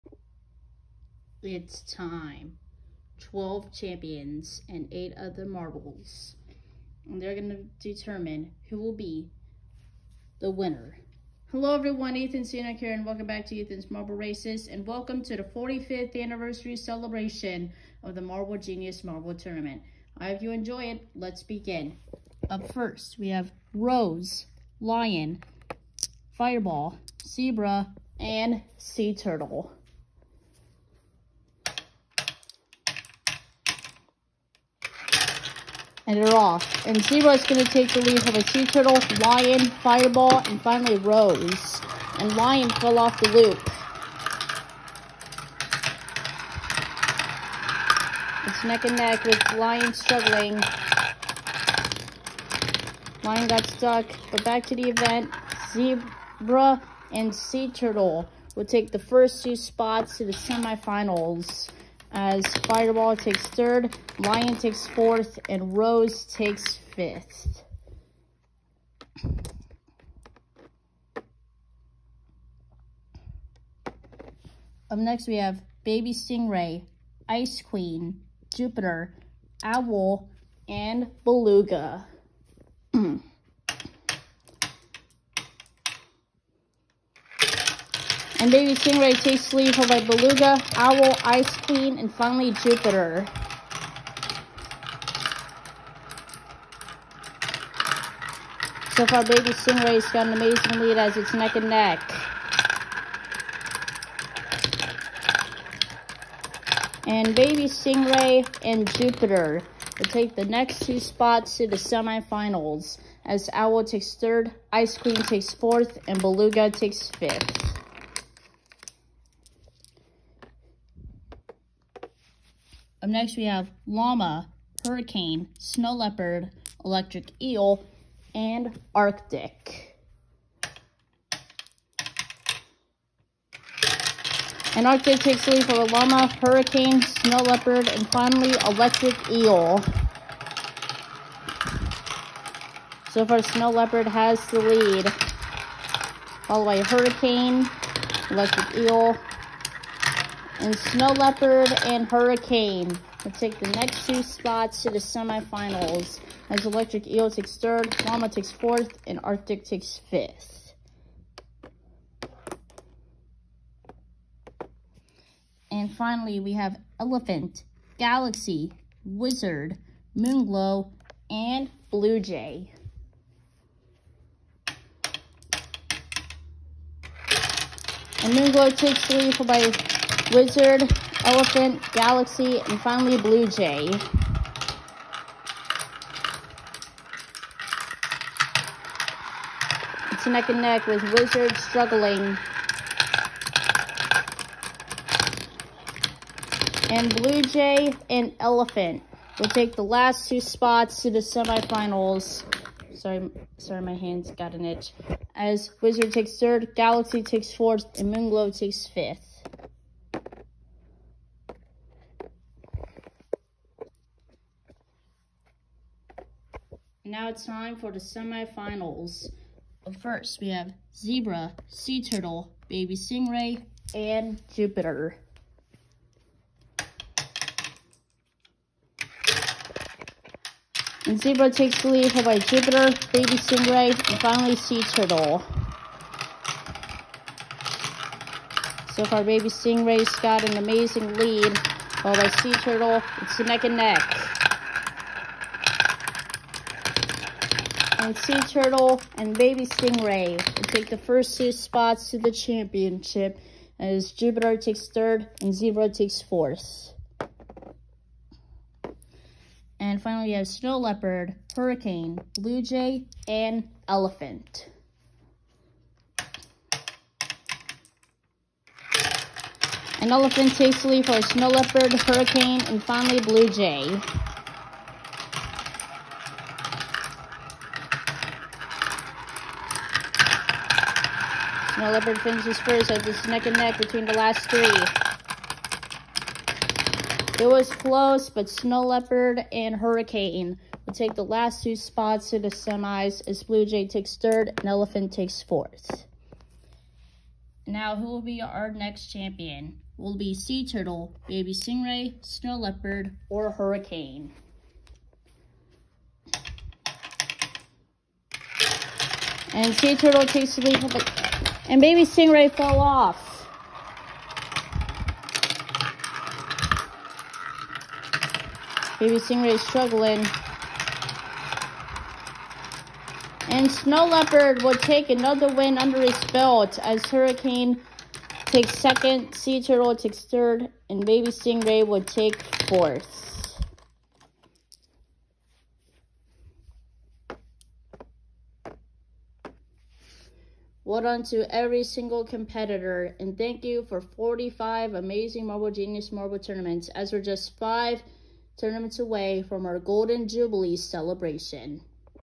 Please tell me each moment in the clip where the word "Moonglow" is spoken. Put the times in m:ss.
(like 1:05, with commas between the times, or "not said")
2:50, 2:58, 3:28.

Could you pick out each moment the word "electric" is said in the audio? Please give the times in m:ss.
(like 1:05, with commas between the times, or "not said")
2:06, 2:18, 2:28, 2:36.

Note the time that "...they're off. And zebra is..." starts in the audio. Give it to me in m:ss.
0:36.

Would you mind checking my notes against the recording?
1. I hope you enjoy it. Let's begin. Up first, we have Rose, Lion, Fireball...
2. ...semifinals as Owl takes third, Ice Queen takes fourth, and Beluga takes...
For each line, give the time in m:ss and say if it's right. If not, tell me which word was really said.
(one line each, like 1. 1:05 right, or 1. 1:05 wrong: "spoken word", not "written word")
1. 0:20 right
2. 1:51 right.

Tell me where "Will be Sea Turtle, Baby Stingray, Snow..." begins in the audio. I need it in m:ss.
4:59.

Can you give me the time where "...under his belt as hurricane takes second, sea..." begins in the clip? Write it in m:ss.
5:25.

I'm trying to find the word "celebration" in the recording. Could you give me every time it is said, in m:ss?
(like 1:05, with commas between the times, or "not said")
0:16, 5:50.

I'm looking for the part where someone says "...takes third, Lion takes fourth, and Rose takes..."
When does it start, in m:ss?
1:03.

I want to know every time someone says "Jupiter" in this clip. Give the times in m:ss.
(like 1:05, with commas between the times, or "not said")
1:18, 1:32, 1:48, 3:44, 3:52, 4:14.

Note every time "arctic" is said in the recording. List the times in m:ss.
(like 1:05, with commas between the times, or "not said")
2:08, 2:14, 2:39.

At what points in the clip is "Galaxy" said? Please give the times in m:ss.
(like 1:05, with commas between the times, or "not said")
2:47, 3:01, 3:26.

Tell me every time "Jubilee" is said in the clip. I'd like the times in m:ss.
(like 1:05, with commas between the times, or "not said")
5:50.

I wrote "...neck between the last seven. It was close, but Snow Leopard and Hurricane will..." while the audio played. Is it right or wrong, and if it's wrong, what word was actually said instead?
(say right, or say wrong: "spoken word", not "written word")
wrong: "three", not "seven".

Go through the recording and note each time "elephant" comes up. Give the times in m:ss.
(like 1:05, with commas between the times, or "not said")
2:46, 3:01, 3:18, 4:23, 4:30, 4:54.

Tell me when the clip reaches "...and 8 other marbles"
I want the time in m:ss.
0:04.